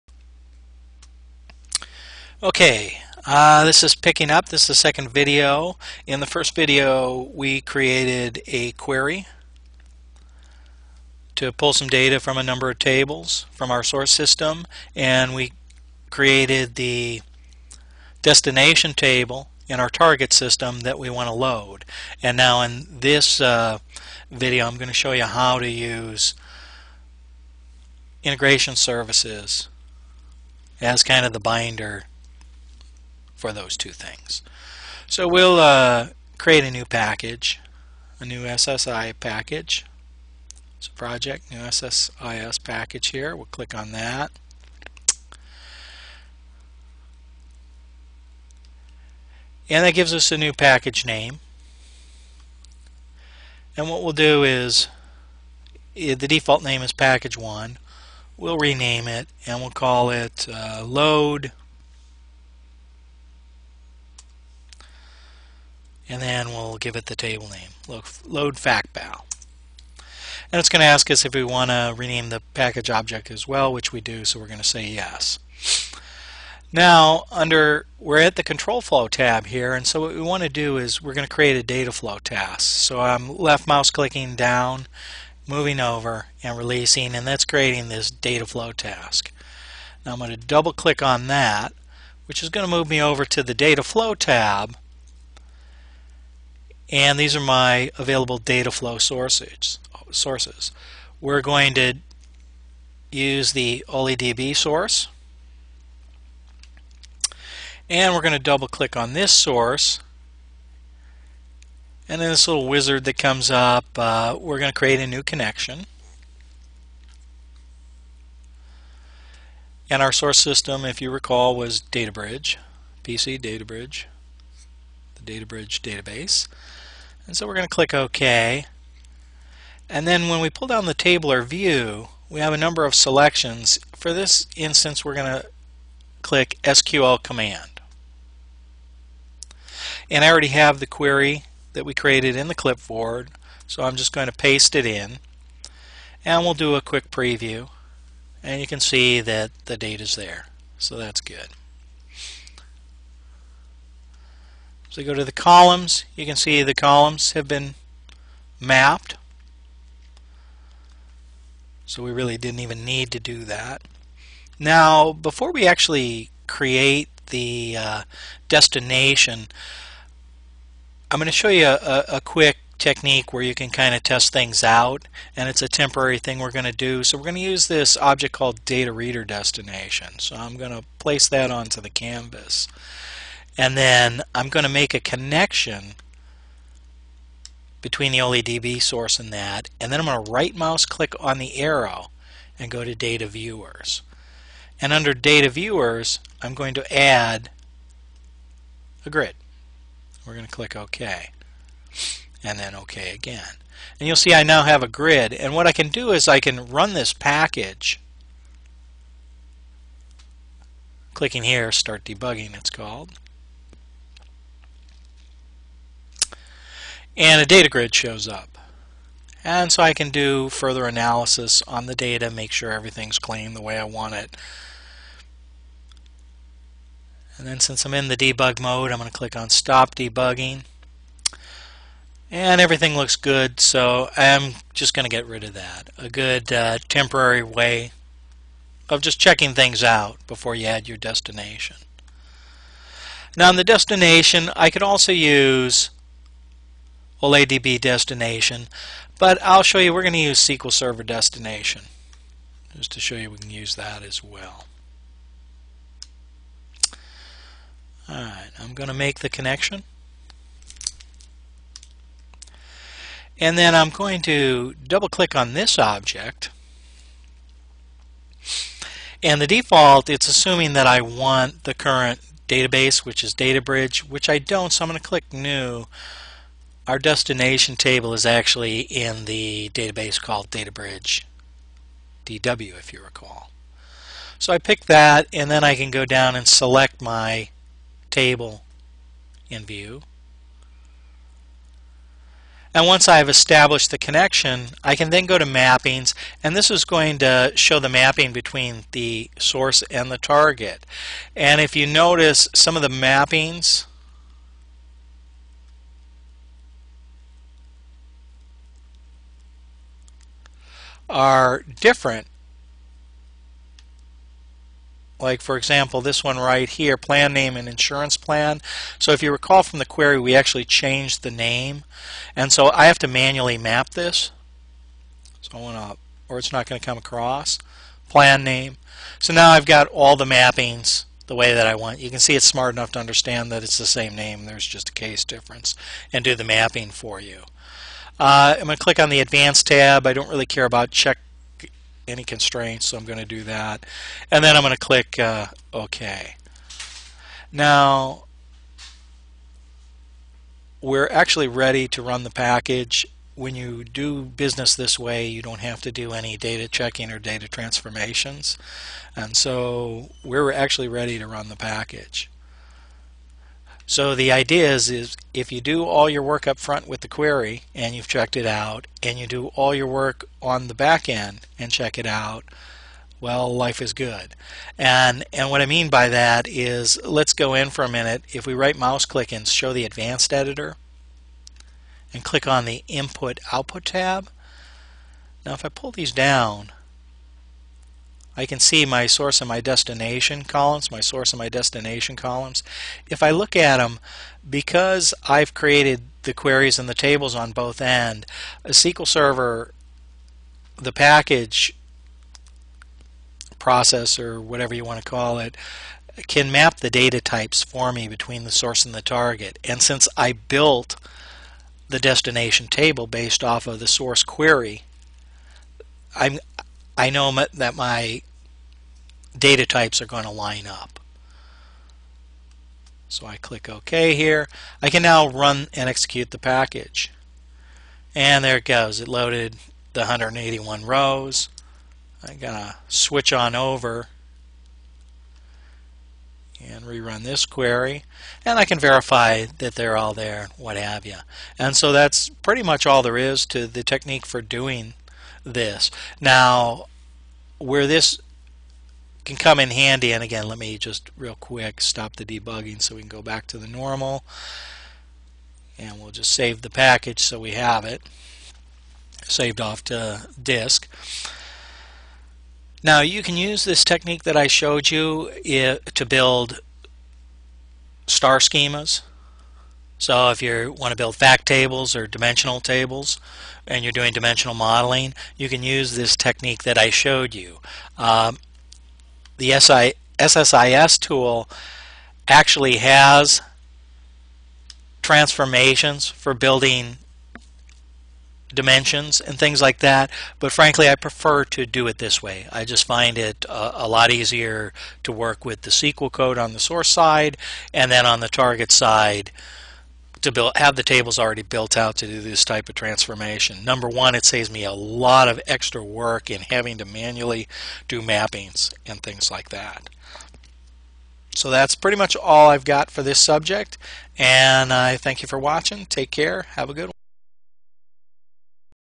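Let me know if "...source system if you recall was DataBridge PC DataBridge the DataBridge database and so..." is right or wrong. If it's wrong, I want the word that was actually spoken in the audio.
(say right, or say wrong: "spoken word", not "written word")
right.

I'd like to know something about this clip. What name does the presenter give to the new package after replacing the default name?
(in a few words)
load factbal.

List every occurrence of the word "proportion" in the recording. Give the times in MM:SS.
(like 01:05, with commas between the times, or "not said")
not said.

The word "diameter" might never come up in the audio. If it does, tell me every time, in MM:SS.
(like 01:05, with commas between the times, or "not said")
not said.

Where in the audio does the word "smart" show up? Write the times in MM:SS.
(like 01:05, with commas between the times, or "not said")
05:32.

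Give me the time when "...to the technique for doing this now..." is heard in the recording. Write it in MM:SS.
07:23.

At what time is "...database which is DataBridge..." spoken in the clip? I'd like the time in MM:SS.
04:32.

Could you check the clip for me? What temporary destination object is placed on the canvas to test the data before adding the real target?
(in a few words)
data reader destination.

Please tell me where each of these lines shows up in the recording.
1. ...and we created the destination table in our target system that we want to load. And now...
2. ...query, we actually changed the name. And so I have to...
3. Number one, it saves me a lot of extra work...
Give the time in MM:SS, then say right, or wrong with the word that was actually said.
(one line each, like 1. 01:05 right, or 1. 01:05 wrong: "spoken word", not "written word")
1. 00:14 right
2. 05:19 right
3. 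08:23 right.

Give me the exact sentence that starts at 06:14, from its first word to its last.
And, and what I mean by that is, let's go in for a minute.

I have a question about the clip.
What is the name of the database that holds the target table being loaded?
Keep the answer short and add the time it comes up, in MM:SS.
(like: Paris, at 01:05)
DataBridge DW, at 04:40.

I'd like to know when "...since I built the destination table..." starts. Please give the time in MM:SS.
06:49.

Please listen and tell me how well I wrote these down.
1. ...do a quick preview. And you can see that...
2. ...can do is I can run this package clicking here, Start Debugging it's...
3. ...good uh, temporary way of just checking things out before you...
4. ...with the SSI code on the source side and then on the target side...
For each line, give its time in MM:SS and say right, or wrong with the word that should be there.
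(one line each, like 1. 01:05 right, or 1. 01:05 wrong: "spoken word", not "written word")
1. 02:26 right
2. 03:25 right
3. 03:56 right
4. 08:15 wrong: "SQL", not "SSI".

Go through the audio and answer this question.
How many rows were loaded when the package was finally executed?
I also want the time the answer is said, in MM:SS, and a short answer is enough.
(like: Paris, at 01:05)
181, at 07:10.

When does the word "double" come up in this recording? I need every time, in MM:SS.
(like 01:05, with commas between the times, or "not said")
01:30, 01:48, 04:24.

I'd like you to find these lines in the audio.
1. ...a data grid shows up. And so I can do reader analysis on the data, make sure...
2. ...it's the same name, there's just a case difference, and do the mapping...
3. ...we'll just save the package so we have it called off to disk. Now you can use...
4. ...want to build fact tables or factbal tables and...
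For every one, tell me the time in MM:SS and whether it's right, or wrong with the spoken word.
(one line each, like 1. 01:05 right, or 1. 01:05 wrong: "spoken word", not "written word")
1. 03:37 wrong: "further", not "reader"
2. 05:33 right
3. 07:35 wrong: "saved", not "called"
4. 07:50 wrong: "dimensional", not "factbal".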